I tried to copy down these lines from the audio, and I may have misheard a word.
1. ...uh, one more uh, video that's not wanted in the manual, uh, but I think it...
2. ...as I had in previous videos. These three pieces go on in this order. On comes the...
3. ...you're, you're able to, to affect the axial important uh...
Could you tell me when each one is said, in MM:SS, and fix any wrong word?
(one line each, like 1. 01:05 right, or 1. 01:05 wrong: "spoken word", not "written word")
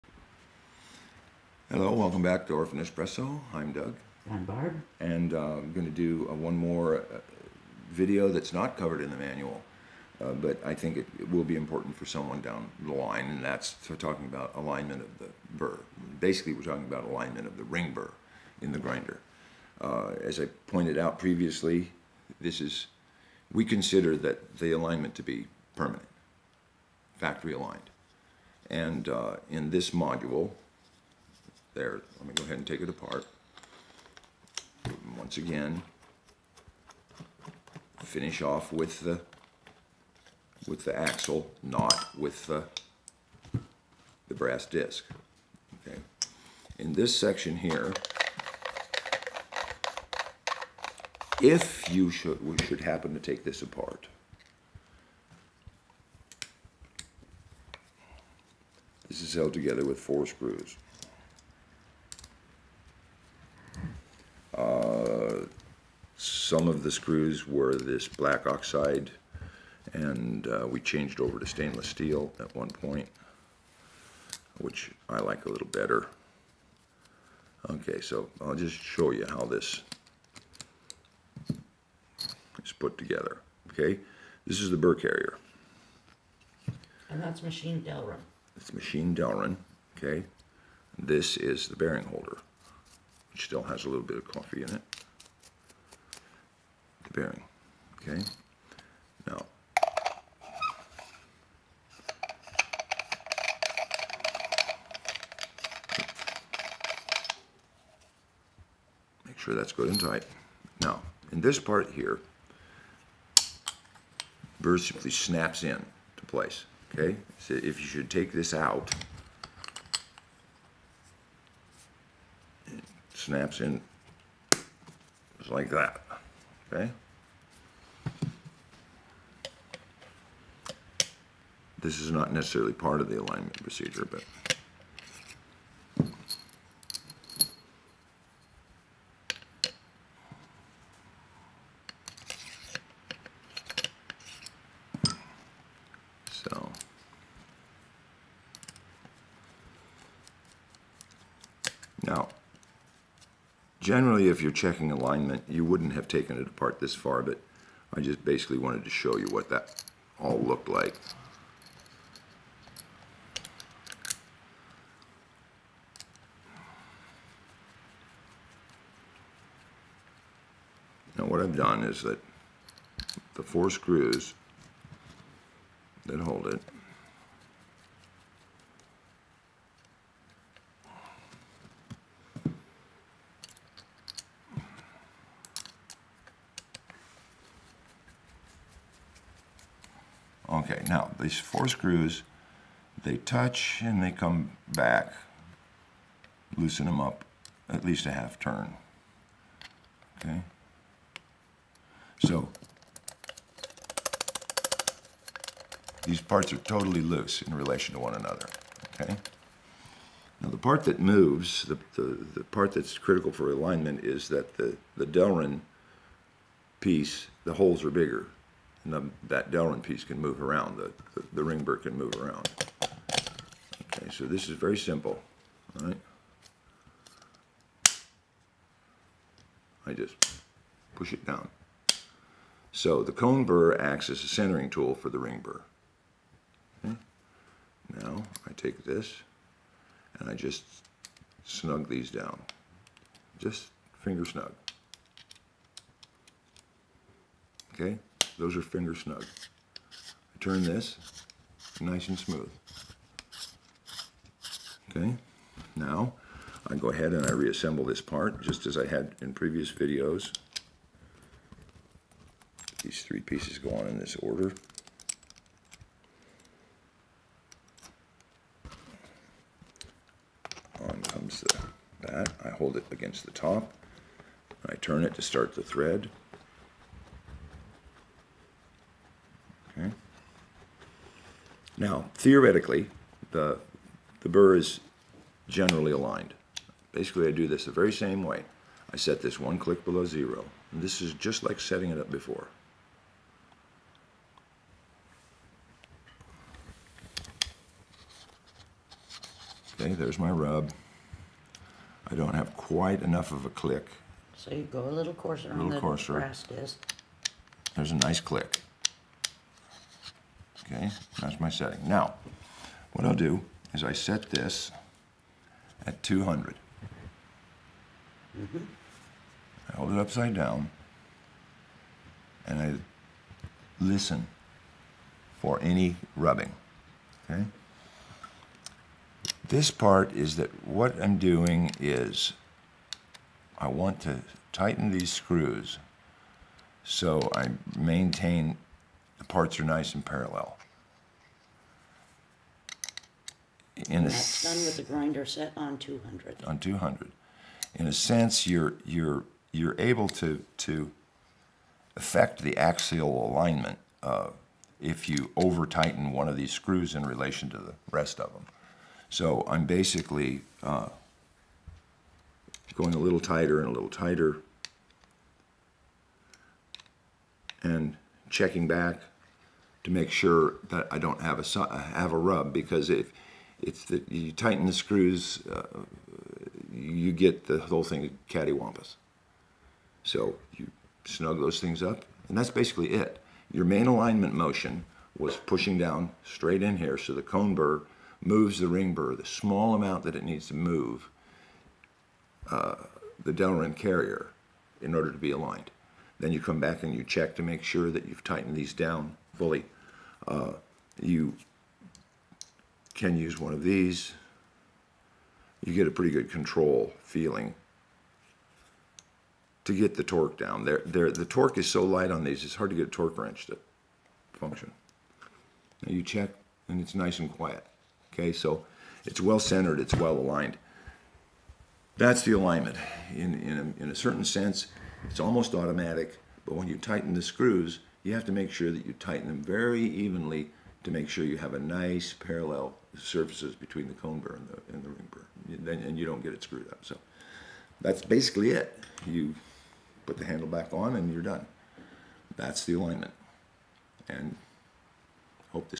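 1. 00:06 wrong: "covered", not "wanted"
2. 04:18 right
3. 05:48 wrong: "alignment", not "important".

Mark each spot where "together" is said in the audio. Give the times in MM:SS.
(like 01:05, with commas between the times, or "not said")
00:59, 01:22.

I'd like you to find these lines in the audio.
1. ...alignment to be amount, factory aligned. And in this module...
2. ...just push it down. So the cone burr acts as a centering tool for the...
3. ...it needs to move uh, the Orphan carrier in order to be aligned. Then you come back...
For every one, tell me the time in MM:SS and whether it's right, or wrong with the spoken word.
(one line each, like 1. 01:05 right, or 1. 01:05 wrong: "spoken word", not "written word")
1. 00:24 wrong: "permanent", not "amount"
2. 03:49 right
3. 06:30 wrong: "Delrin", not "Orphan".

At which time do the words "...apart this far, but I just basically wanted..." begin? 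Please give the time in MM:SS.
02:36.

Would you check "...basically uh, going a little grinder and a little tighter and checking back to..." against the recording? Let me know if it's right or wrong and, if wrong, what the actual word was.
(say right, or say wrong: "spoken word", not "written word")
wrong: "tighter", not "grinder".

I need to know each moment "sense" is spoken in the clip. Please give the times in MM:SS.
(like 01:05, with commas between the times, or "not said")
05:47, 07:04.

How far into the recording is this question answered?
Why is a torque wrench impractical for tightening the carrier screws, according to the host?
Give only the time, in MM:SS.
06:51.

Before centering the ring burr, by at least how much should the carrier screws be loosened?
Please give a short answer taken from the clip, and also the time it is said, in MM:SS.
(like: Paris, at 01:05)
half turn, at 03:18.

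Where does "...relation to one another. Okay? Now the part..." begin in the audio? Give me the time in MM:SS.
03:27.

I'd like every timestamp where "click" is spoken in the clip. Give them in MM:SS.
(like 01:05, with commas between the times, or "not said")
04:49, 05:03, 05:08.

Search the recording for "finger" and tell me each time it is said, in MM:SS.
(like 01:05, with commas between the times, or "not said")
04:04, 04:08.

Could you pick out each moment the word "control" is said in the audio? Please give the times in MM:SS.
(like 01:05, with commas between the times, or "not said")
06:46.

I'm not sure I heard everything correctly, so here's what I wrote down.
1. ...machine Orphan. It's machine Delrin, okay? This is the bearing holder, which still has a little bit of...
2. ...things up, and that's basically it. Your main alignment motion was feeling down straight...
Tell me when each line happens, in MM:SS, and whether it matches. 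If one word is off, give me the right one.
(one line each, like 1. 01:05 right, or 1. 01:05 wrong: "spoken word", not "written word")
1. 01:27 wrong: "Delrin", not "Orphan"
2. 06:21 wrong: "pushing", not "feeling".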